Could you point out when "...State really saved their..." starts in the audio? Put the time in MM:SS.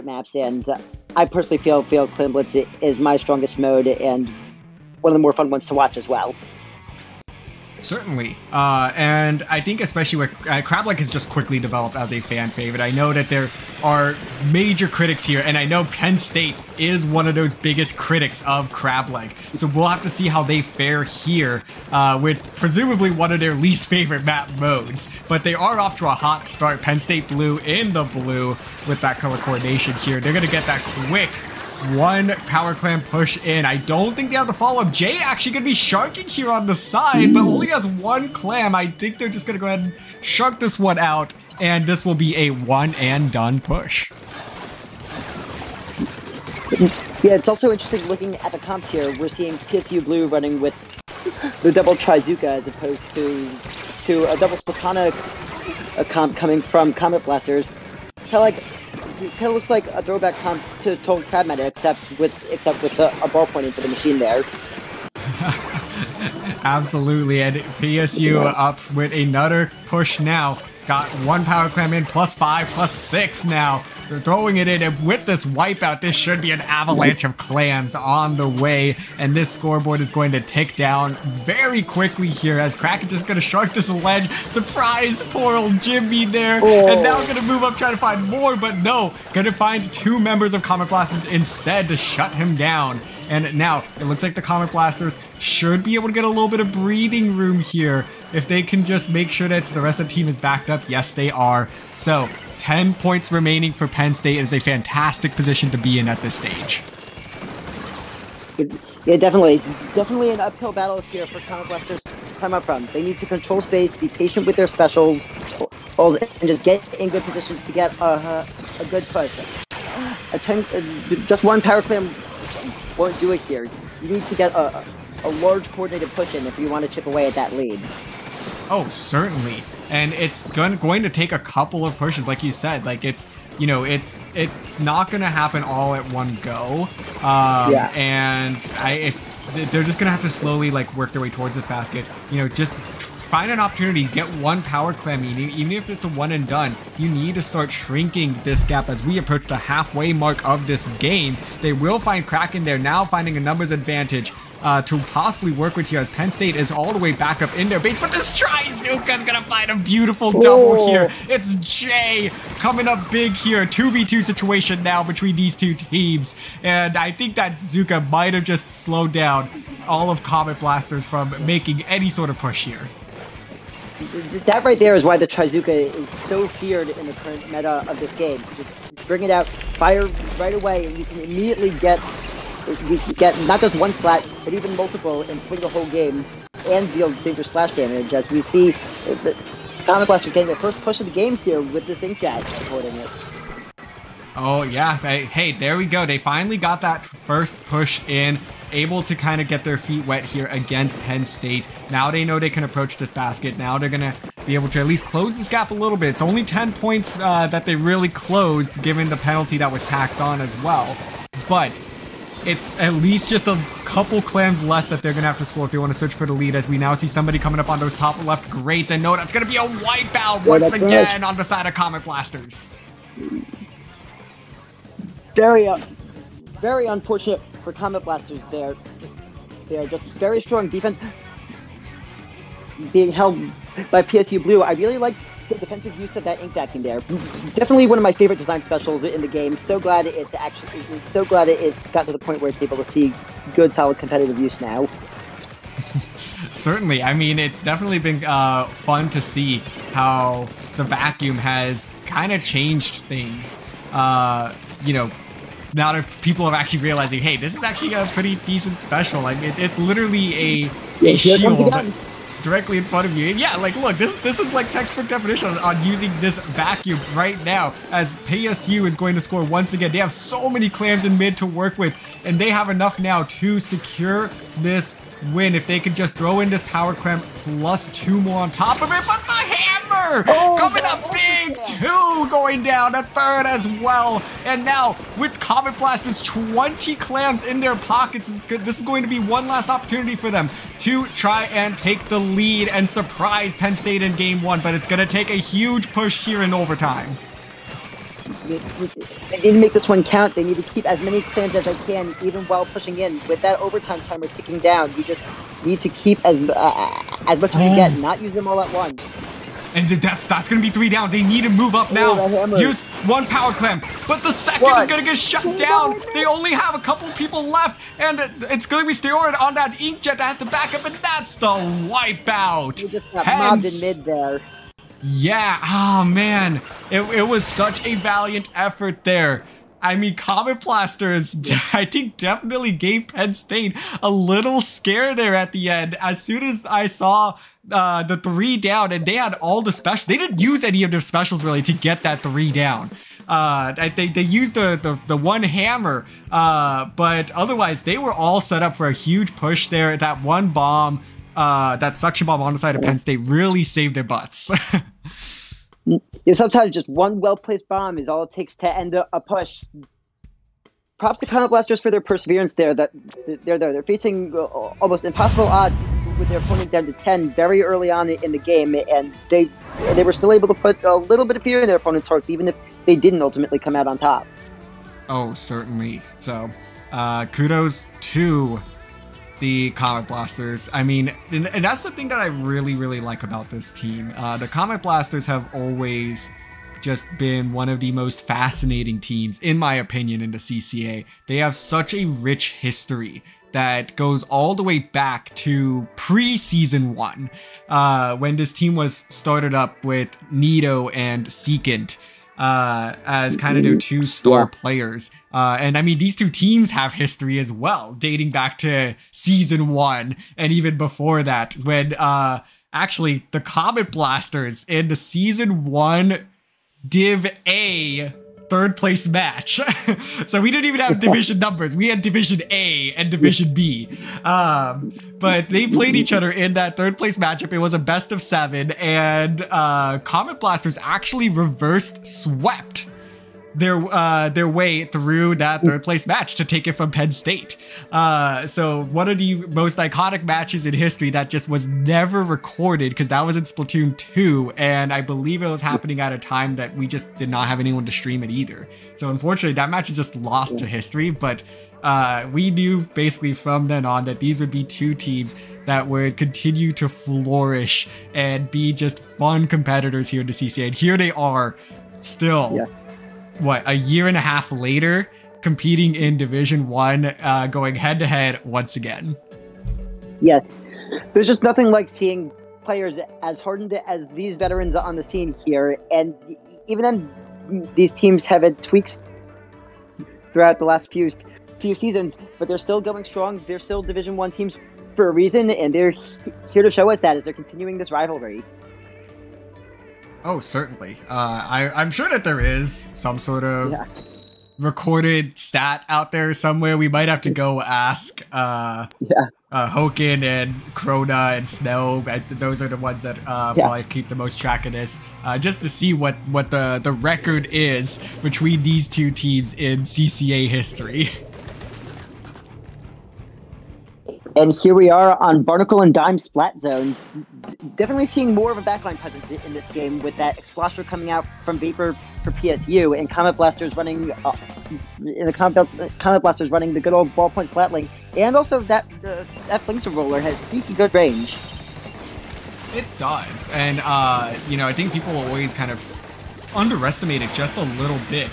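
05:52.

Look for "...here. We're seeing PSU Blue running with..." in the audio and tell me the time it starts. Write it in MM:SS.
00:48.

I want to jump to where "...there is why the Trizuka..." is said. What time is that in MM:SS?
02:54.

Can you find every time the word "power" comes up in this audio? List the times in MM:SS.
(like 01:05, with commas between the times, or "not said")
00:32, 01:11, 02:01, 02:24, 04:36, 05:13.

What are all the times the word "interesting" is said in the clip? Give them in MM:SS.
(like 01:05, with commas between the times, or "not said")
00:47.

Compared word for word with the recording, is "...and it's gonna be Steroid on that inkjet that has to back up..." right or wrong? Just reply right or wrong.
right.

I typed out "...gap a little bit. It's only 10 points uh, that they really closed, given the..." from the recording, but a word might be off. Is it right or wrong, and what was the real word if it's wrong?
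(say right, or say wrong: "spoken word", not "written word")
right.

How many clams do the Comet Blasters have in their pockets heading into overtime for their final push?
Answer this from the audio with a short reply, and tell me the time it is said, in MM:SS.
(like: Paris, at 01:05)
20, at 04:46.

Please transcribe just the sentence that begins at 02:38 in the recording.
But this Trizuka's going to find a beautiful double Ooh.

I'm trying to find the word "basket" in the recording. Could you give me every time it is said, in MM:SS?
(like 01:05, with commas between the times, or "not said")
02:21, 03:23.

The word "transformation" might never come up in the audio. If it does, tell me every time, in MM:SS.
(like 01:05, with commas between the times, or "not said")
not said.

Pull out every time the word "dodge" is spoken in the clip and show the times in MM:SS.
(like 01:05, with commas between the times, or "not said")
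not said.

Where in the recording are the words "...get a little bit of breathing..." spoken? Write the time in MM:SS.
01:36.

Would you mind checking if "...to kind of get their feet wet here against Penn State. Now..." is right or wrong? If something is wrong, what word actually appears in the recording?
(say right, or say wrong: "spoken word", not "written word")
right.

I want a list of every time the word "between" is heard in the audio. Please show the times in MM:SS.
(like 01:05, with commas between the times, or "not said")
02:45, 08:28.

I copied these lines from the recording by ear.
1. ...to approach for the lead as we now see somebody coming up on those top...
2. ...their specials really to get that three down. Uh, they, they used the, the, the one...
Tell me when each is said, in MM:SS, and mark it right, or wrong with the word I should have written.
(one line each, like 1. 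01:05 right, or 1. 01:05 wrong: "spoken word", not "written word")
1. 03:35 wrong: "search", not "approach"
2. 05:40 right.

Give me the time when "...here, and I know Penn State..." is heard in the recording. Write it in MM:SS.
00:15.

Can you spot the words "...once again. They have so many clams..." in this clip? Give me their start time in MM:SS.
04:29.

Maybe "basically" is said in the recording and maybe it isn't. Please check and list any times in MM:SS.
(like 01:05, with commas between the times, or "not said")
07:32.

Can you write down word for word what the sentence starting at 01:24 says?
Surprise, poor old Jimmy there, oh.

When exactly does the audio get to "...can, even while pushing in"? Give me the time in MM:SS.
05:01.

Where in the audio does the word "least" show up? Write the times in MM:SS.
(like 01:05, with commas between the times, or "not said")
00:23, 03:24, 03:32.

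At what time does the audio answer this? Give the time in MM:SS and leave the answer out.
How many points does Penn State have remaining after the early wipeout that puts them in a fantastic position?
01:42.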